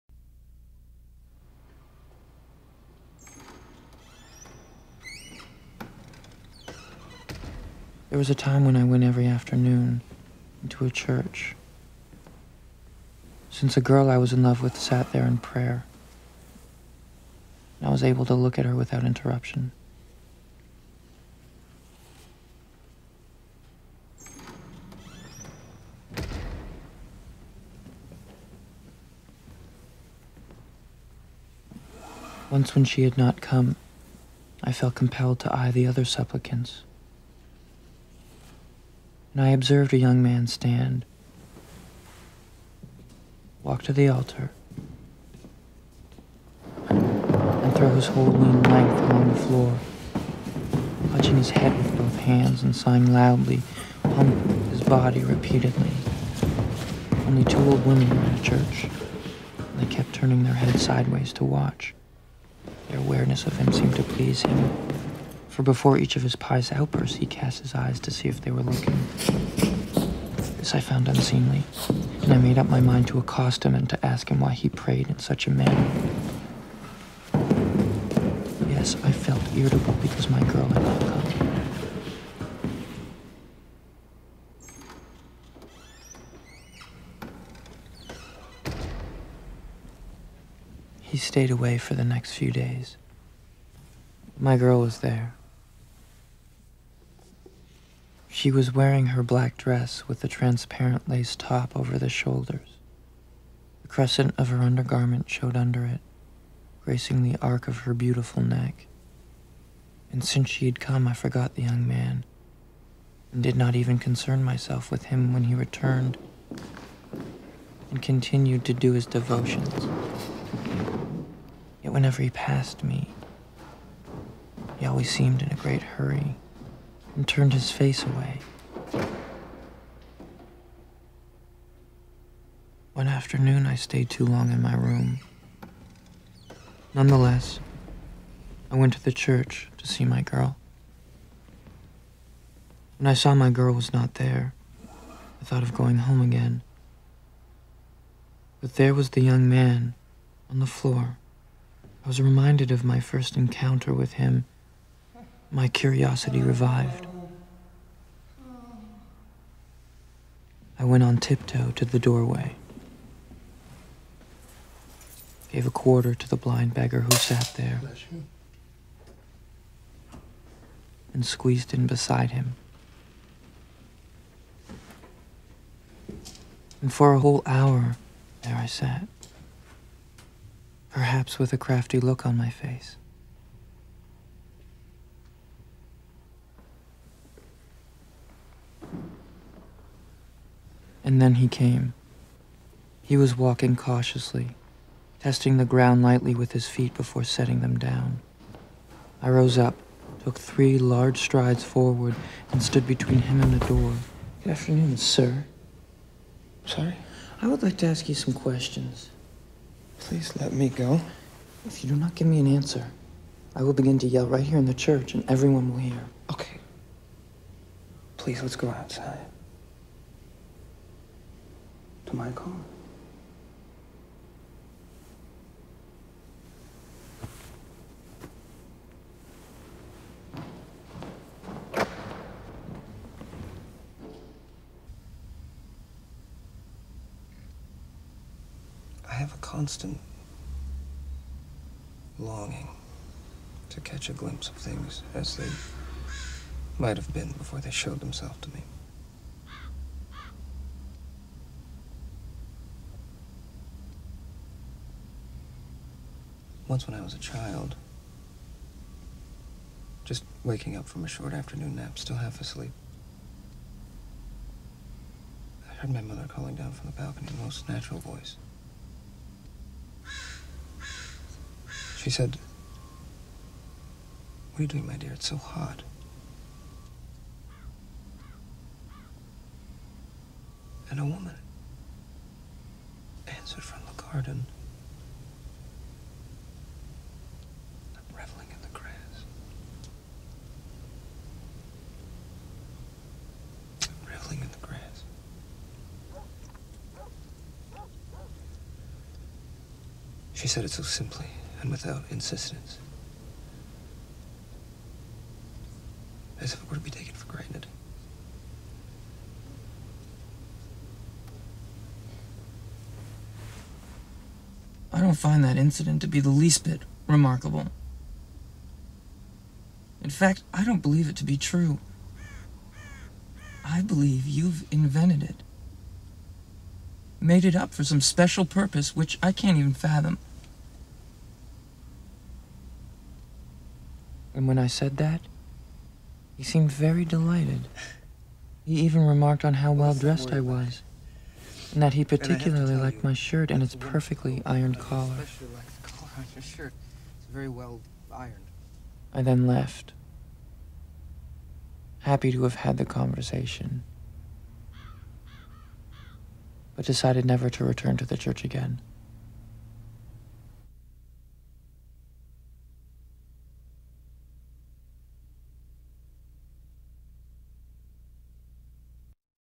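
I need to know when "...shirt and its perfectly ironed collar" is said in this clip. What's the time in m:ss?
5:43.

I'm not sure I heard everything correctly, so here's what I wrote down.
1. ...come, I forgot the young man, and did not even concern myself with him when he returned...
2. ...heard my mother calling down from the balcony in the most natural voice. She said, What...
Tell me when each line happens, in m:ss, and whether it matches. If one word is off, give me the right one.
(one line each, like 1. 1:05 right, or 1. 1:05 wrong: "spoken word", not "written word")
1. 1:50 right
2. 4:25 right.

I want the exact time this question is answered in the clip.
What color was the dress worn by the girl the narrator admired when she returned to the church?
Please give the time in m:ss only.
1:39.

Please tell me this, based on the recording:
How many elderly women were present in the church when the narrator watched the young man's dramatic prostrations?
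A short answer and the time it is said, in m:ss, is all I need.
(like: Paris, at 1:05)
2, at 0:57.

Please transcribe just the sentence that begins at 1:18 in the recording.
Yes, I felt irritable because my girl had not come.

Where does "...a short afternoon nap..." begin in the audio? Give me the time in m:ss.
4:21.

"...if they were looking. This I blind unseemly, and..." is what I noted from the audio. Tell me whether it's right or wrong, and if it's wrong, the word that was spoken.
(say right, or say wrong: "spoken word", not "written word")
wrong: "found", not "blind".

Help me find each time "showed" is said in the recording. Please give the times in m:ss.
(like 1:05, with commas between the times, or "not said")
1:45, 4:07.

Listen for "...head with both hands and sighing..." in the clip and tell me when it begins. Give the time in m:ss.
0:51.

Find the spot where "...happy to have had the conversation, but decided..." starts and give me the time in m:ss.
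5:51.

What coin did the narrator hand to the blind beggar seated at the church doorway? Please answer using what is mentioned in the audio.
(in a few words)
A quarter.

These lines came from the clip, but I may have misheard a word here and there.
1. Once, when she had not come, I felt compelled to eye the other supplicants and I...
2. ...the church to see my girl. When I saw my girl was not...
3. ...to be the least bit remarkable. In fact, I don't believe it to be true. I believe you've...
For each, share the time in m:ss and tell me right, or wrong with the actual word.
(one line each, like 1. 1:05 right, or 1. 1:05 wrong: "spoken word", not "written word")
1. 0:32 right
2. 2:19 right
3. 5:16 right.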